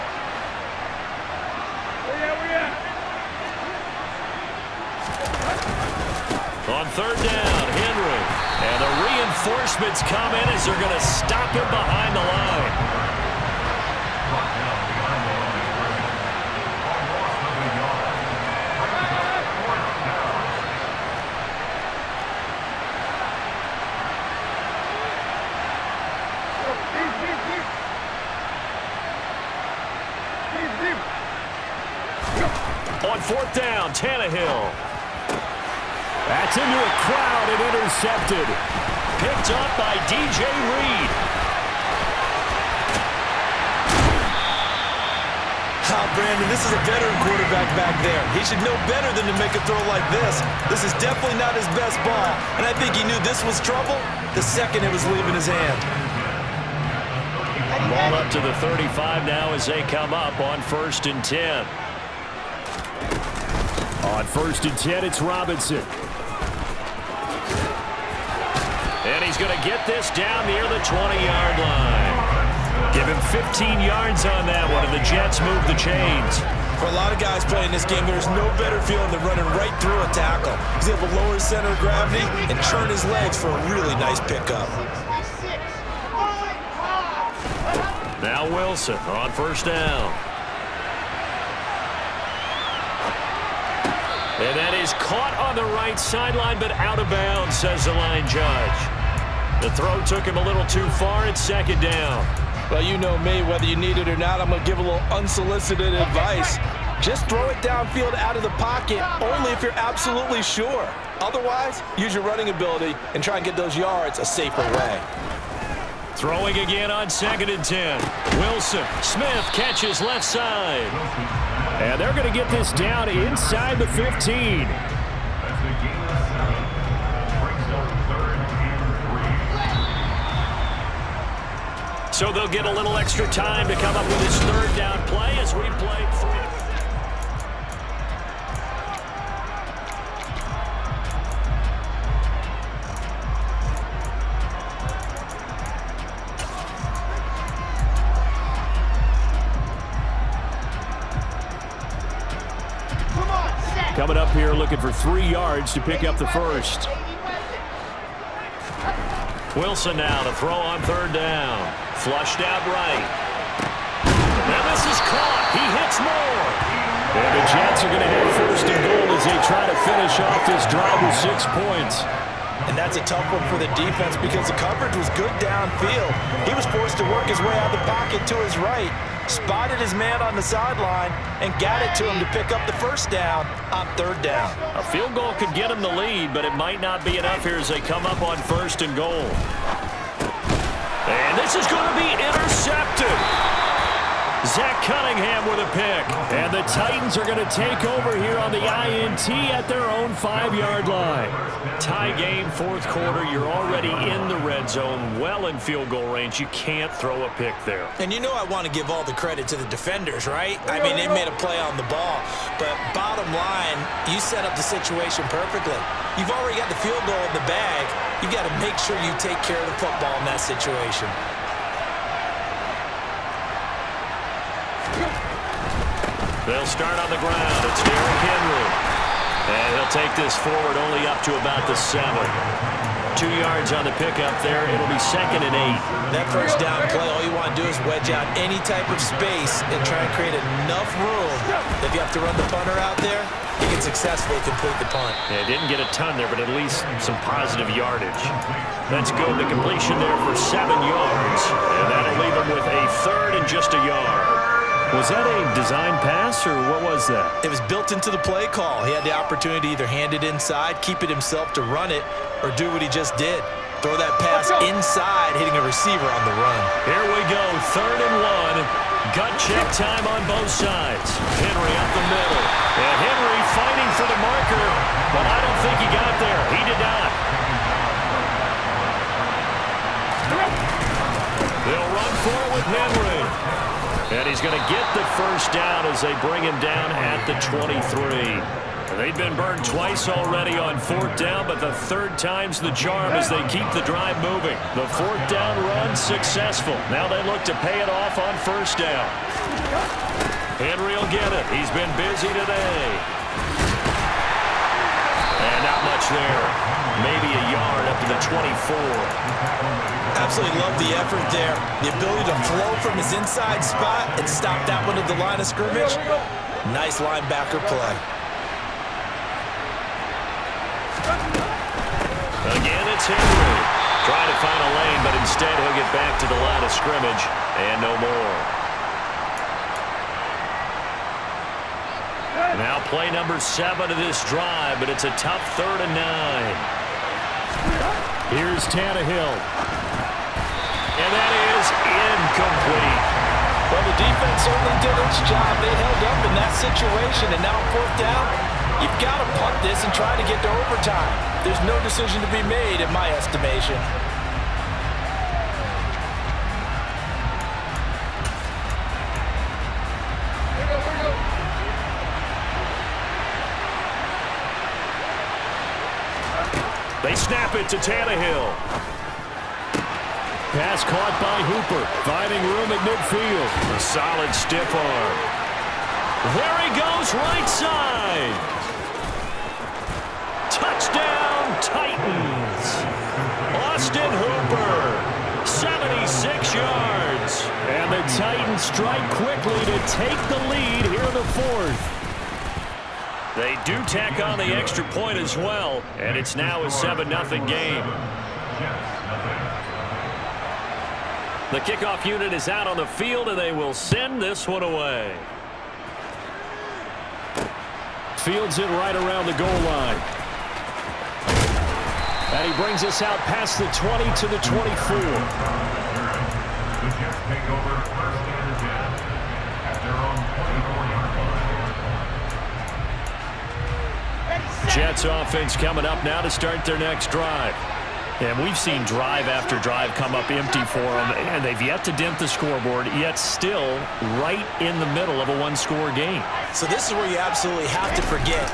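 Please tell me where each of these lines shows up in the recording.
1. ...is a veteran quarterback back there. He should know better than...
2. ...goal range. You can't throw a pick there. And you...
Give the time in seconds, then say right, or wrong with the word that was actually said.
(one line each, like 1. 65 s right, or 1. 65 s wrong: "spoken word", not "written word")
1. 46 s right
2. 205 s right.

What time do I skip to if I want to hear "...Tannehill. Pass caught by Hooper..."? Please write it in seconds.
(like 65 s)
367 s.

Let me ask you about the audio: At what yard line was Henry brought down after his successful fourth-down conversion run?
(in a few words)
23.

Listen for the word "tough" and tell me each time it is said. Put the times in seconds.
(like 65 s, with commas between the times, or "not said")
173 s, 335 s.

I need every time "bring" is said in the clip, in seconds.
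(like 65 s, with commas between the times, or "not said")
286 s, 412 s.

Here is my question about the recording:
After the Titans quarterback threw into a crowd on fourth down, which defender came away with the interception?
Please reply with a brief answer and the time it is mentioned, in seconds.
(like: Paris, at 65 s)
D.J. Reed, at 40 s.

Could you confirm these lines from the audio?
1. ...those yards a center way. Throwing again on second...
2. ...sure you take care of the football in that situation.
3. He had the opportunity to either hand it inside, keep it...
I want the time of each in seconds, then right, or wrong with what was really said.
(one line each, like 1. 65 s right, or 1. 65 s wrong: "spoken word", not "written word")
1. 113 s wrong: "safer", not "center"
2. 218 s right
3. 258 s right.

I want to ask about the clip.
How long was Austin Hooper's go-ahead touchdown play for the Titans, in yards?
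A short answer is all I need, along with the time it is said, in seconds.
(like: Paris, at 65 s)
76, at 385 s.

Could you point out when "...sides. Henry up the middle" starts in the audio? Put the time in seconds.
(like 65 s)
270 s.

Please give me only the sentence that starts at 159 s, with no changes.
Wilson now to throw on third down.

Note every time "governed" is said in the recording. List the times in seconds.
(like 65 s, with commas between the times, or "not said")
not said.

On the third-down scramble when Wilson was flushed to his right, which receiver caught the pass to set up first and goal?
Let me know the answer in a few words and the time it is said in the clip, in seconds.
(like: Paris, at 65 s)
Moore, at 166 s.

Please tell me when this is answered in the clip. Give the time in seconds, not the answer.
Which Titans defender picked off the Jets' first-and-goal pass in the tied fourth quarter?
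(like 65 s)
194 s.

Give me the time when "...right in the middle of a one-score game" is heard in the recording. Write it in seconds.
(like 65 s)
434 s.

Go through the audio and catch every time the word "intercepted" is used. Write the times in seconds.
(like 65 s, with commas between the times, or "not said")
37 s, 192 s.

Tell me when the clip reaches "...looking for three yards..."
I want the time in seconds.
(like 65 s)
154 s.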